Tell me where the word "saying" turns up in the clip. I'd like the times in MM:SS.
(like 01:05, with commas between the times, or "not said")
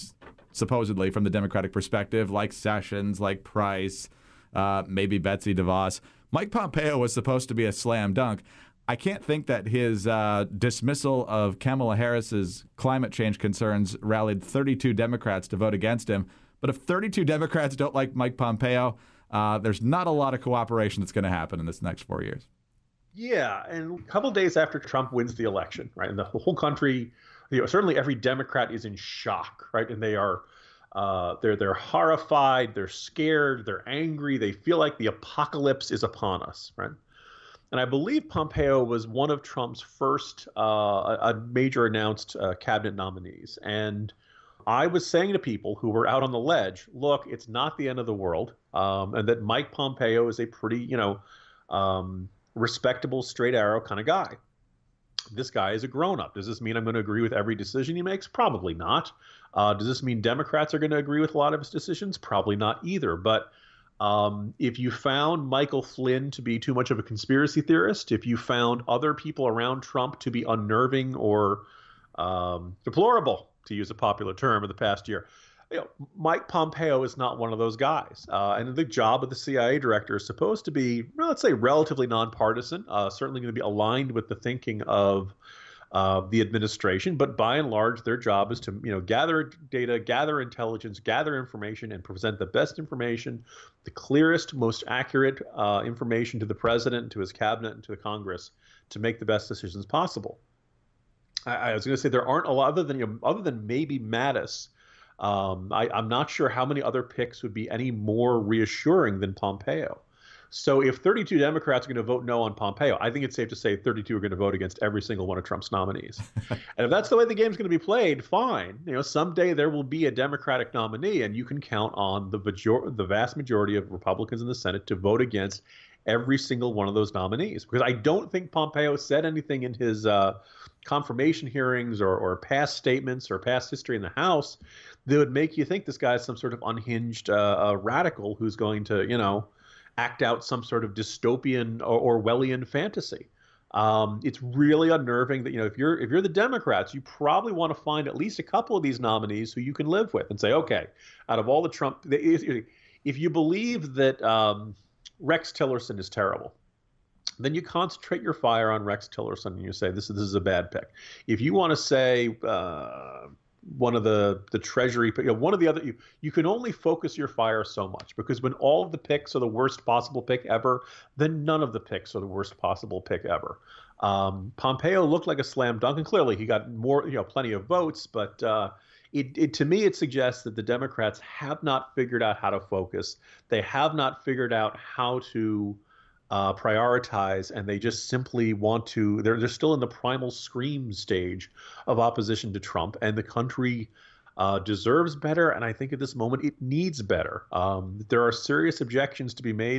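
00:45.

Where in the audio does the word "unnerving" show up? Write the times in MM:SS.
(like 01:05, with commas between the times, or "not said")
01:10, 02:24.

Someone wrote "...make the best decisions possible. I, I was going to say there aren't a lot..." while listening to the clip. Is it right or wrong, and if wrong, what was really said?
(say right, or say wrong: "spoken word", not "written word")
right.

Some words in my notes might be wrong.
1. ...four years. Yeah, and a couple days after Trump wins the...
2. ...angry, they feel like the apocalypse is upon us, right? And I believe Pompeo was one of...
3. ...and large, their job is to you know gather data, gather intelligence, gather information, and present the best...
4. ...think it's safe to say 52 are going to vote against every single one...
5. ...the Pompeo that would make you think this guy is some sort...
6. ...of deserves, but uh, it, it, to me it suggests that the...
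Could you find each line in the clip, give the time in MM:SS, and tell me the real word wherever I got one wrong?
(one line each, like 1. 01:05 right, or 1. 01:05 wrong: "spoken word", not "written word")
1. 00:22 right
2. 00:33 right
3. 01:27 right
4. 01:53 wrong: "32", not "52"
5. 02:14 wrong: "House", not "Pompeo"
6. 02:57 wrong: "votes", not "deserves".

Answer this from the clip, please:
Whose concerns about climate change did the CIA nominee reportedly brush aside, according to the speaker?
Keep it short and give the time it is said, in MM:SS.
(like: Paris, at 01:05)
Kamala Harris, at 00:11.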